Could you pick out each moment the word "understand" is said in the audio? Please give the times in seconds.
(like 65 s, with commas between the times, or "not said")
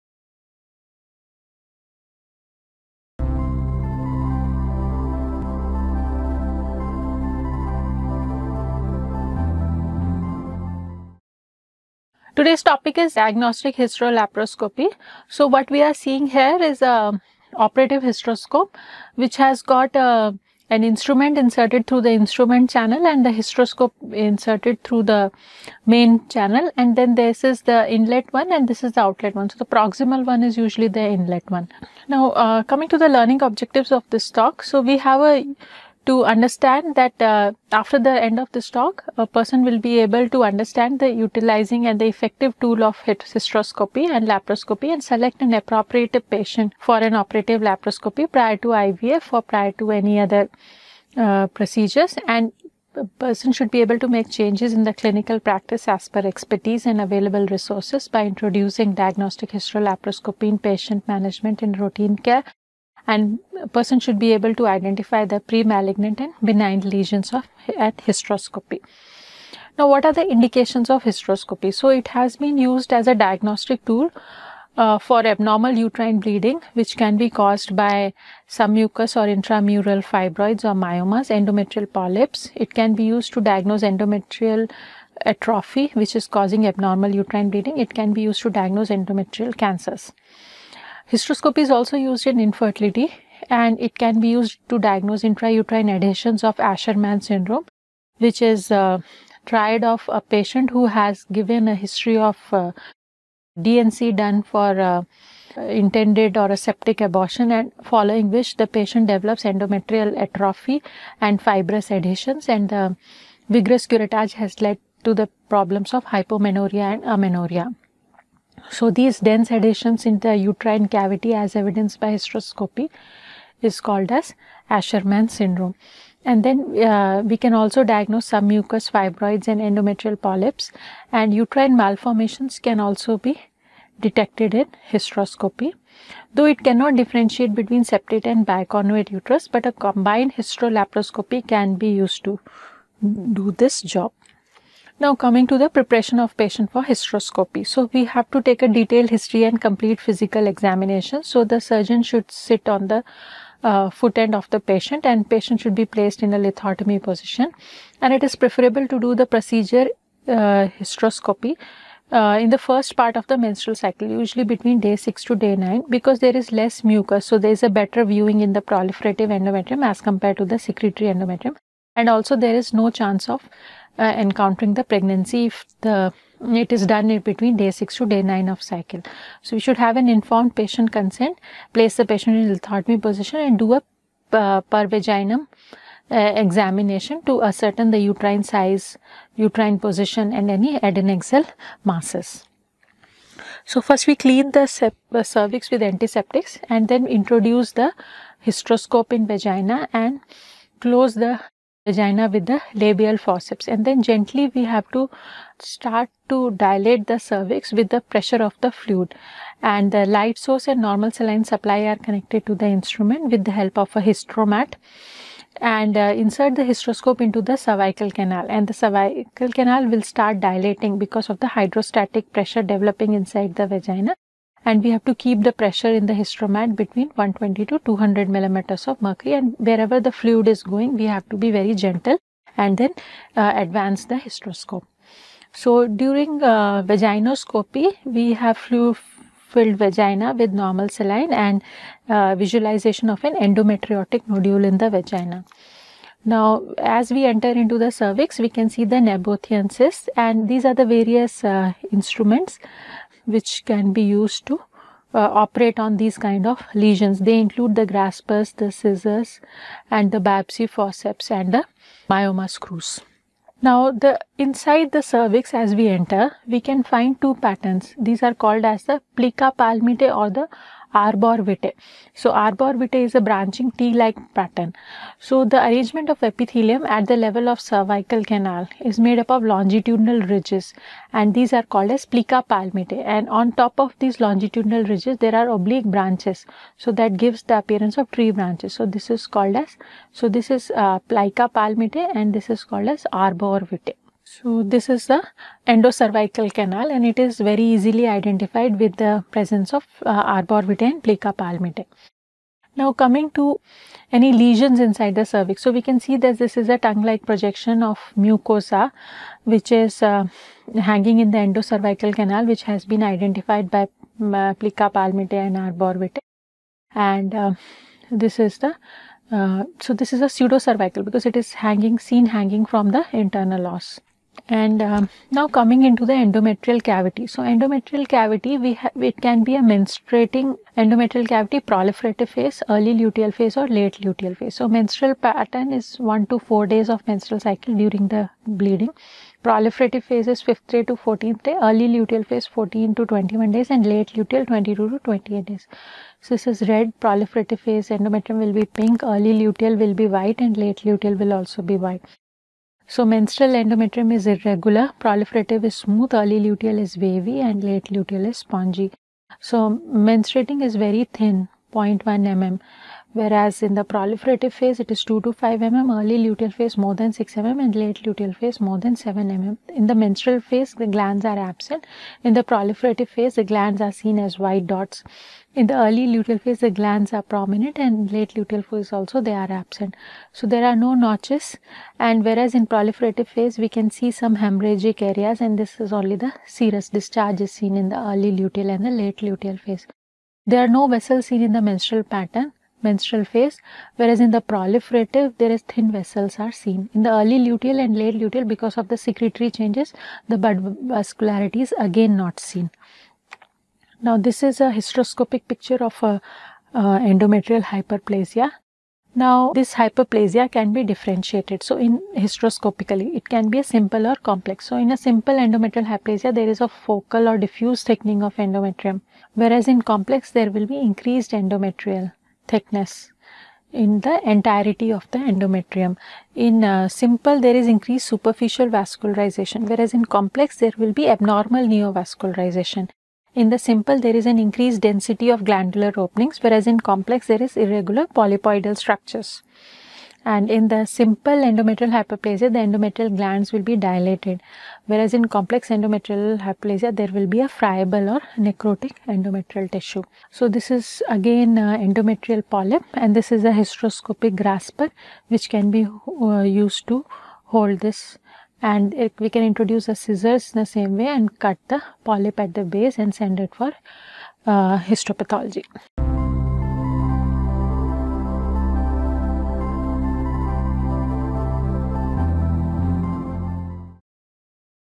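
36 s, 40 s.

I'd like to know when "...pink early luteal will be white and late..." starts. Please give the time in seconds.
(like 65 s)
348 s.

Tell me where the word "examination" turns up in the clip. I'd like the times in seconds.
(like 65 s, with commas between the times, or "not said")
150 s, 186 s.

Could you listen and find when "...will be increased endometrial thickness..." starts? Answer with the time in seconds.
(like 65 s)
420 s.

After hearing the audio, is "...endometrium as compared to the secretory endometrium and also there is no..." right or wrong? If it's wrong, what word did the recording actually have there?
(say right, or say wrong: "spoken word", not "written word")
right.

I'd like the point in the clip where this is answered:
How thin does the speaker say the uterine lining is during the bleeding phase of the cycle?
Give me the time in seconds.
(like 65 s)
361 s.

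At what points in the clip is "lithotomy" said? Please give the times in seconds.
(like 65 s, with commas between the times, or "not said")
156 s, 182 s.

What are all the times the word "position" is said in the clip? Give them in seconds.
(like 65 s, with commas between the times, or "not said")
157 s, 182 s, 189 s.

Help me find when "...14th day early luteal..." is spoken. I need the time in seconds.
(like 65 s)
340 s.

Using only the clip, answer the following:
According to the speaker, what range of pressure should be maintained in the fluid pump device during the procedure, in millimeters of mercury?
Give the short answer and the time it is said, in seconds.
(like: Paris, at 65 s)
120 to 200, at 227 s.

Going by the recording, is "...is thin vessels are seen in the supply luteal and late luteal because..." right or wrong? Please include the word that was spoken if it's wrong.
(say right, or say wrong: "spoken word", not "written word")
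wrong: "early", not "supply".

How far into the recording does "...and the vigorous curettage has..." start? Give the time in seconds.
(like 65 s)
112 s.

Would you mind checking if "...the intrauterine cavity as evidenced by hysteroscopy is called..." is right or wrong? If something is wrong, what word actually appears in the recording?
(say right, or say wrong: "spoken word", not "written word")
wrong: "uterine", not "intrauterine".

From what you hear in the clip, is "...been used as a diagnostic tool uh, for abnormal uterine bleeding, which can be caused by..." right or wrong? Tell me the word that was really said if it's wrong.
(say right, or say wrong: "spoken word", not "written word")
right.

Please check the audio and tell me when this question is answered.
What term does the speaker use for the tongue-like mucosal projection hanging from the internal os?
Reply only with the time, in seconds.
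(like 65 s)
320 s.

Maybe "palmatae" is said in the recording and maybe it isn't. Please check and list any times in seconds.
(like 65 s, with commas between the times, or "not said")
269 s, 282 s, 291 s, 301 s, 314 s.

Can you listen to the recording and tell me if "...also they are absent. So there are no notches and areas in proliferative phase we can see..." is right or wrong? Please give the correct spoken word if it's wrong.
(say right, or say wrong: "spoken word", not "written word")
wrong: "whereas", not "areas".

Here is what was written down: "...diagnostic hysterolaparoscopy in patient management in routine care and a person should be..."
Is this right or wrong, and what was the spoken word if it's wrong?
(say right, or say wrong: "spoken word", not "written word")
right.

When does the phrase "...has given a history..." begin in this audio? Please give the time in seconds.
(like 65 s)
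100 s.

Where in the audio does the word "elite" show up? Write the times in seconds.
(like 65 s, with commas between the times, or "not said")
not said.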